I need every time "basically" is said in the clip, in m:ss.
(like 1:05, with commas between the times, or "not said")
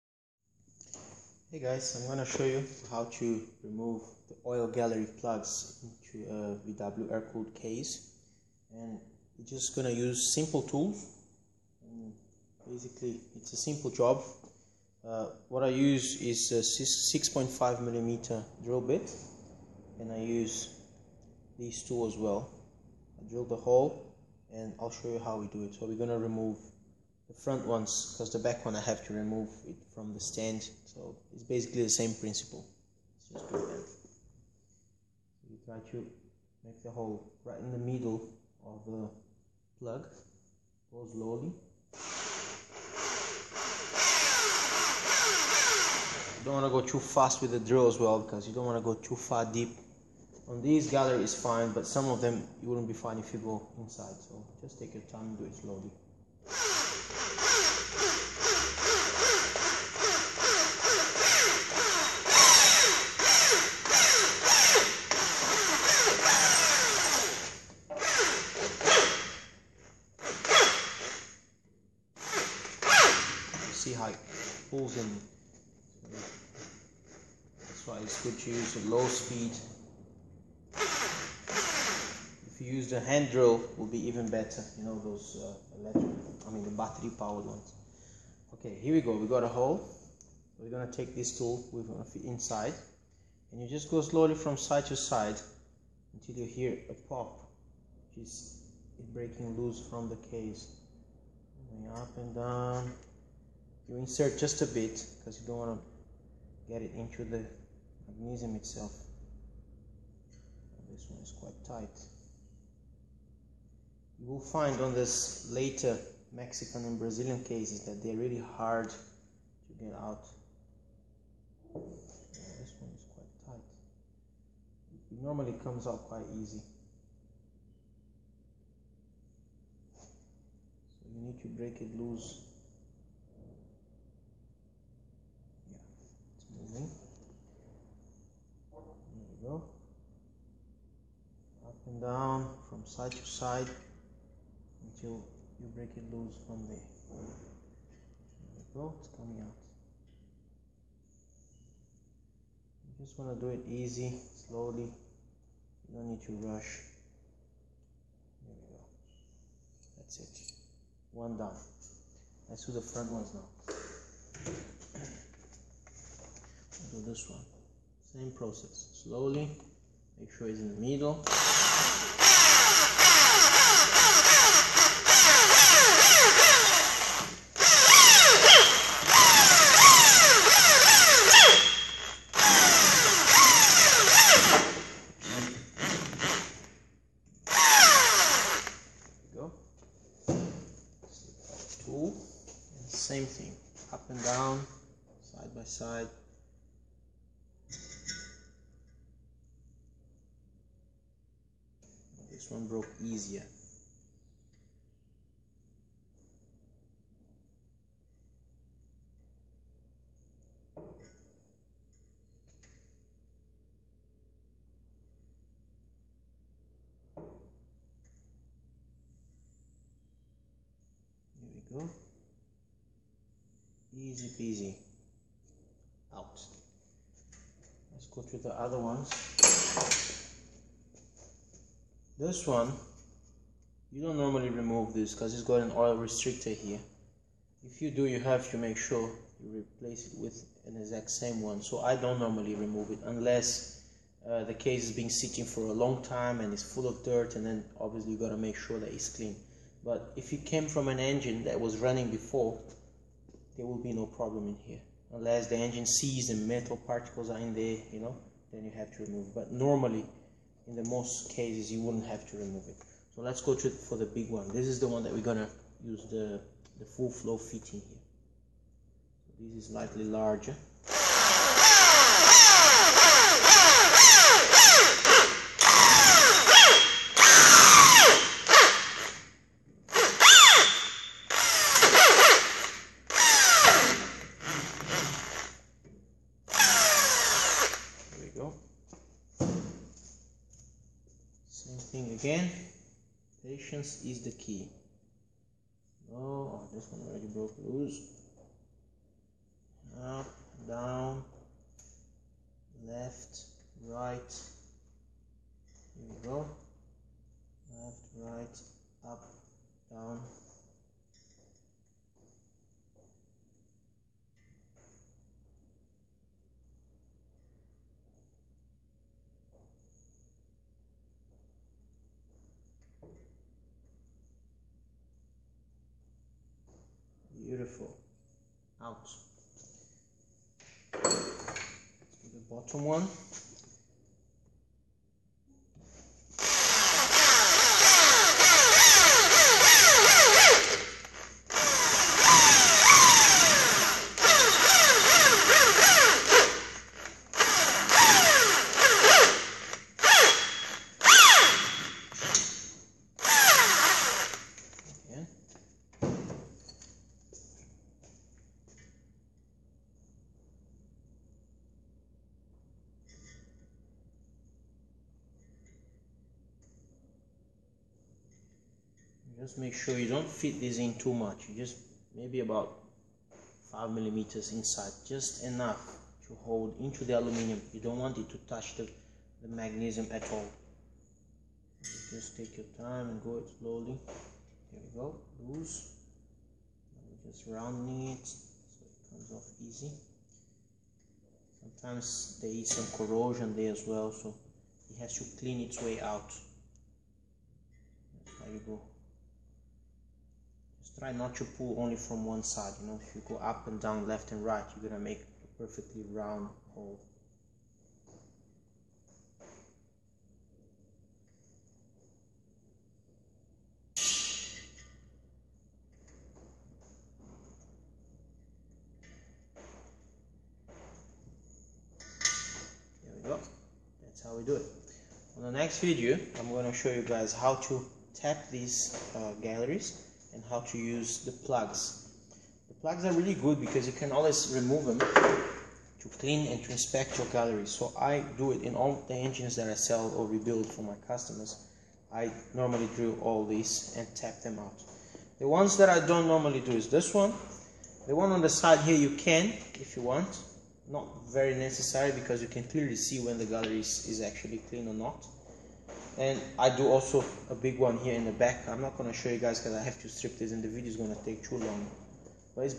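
0:12, 0:31.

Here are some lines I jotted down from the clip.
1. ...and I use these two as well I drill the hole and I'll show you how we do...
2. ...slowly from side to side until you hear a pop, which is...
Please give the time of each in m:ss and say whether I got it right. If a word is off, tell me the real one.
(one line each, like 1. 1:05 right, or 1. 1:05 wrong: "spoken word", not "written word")
1. 0:19 right
2. 1:34 right.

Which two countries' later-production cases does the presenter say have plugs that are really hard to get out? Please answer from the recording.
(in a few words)
Mexican and Brazilian.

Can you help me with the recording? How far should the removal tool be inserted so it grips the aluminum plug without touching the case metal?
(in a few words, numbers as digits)
about 5 millimeters.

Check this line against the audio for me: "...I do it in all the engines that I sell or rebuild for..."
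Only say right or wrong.
right.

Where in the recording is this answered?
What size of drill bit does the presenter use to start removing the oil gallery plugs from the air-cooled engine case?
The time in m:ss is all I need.
0:16.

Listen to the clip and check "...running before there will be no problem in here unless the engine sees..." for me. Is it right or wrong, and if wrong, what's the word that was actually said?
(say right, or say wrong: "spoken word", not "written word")
right.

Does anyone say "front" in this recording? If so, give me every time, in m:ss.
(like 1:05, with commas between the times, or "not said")
0:27, 2:42.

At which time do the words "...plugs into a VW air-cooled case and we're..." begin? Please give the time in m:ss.
0:05.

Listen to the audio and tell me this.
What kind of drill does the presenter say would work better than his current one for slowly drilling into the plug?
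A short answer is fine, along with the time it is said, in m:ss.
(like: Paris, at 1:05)
battery powered, at 1:26.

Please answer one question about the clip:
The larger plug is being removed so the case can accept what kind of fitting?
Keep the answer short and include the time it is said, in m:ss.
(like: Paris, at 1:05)
full flow fitting, at 4:26.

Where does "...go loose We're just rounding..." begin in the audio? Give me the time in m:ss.
6:24.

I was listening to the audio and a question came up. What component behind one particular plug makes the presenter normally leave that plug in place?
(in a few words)
oil restrictor.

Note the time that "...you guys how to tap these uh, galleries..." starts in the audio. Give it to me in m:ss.
7:06.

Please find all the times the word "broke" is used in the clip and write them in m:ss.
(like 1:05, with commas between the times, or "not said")
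3:22, 4:57.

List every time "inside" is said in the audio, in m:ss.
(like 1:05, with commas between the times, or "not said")
0:53, 1:32, 6:14.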